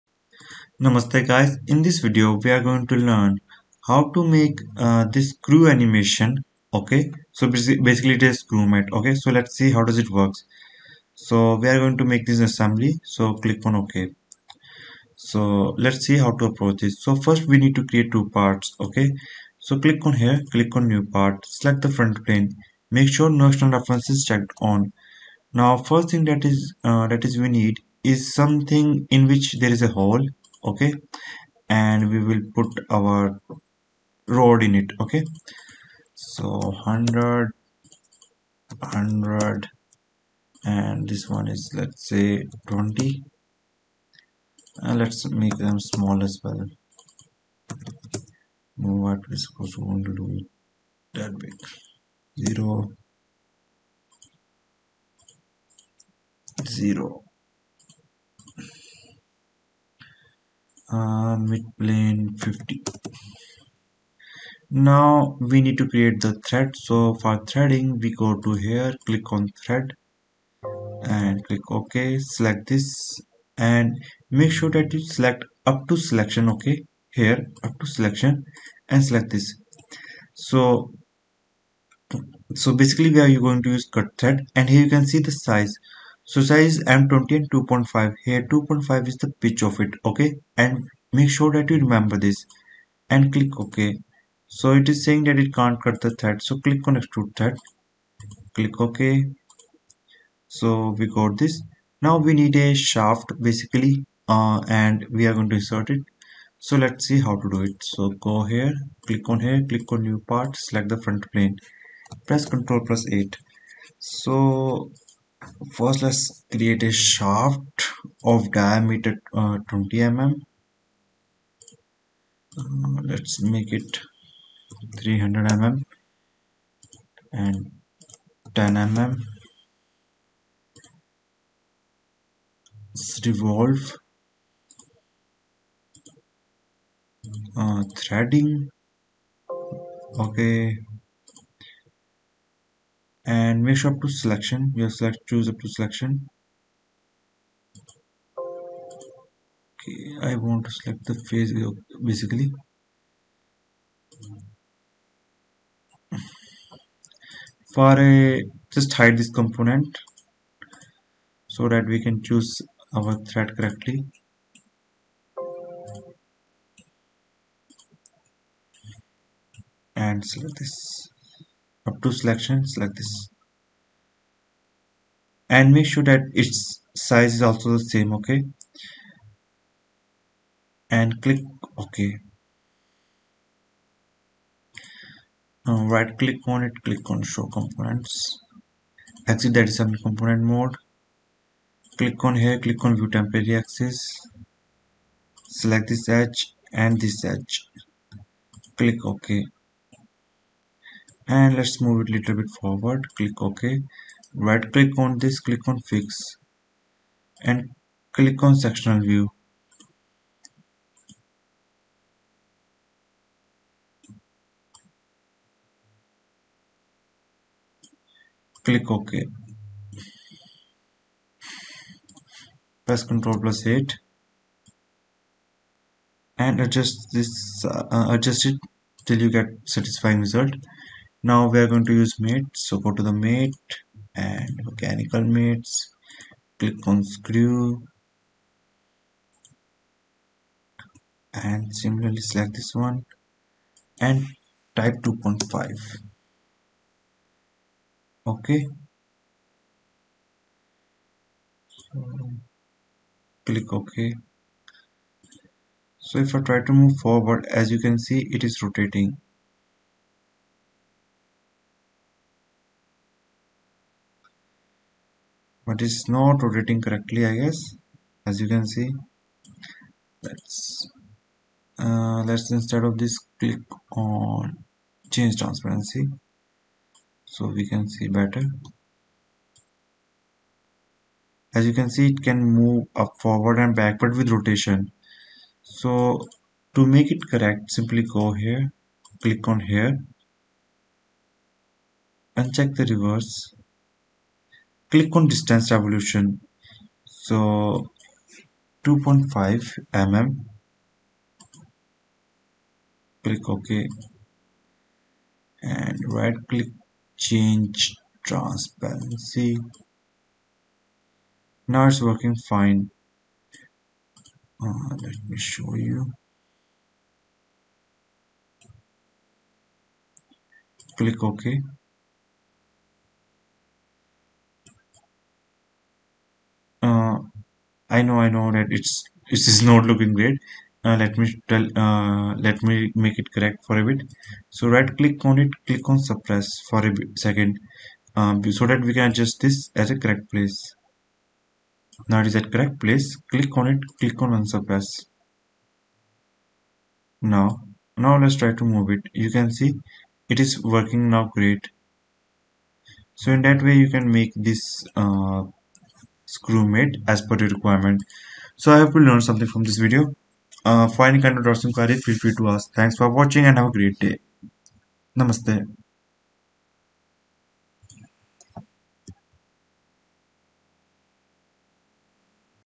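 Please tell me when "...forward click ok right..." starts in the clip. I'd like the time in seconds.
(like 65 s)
202 s.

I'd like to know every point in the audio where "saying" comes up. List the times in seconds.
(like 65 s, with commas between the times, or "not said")
95 s.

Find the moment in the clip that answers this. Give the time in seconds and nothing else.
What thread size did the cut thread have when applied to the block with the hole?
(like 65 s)
86 s.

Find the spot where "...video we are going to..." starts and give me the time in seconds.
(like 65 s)
1 s.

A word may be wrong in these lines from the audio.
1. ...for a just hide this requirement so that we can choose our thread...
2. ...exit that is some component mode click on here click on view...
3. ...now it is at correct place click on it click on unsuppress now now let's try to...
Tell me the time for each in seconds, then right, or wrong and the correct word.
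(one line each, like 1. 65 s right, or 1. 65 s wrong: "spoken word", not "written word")
1. 157 s wrong: "component", not "requirement"
2. 189 s right
3. 342 s right.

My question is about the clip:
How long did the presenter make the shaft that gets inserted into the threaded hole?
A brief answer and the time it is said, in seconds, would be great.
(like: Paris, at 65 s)
300 mm, at 124 s.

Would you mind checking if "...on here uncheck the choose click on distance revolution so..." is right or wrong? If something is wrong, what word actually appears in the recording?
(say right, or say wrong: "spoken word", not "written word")
wrong: "reverse", not "choose".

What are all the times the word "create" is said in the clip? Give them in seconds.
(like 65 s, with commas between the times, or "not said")
17 s, 65 s, 116 s.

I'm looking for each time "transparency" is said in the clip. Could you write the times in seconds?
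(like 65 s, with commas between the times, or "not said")
275 s, 308 s.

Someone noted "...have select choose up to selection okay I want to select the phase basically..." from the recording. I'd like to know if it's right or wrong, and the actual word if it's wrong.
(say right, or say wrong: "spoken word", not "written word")
right.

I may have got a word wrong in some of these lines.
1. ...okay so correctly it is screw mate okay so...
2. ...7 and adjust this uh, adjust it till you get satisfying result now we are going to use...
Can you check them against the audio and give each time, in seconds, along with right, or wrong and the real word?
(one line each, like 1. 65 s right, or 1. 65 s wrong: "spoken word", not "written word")
1. 6 s wrong: "basically", not "correctly"
2. 223 s wrong: "8", not "7".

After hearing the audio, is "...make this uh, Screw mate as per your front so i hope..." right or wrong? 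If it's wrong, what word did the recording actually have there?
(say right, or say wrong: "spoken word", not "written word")
wrong: "requirement", not "front".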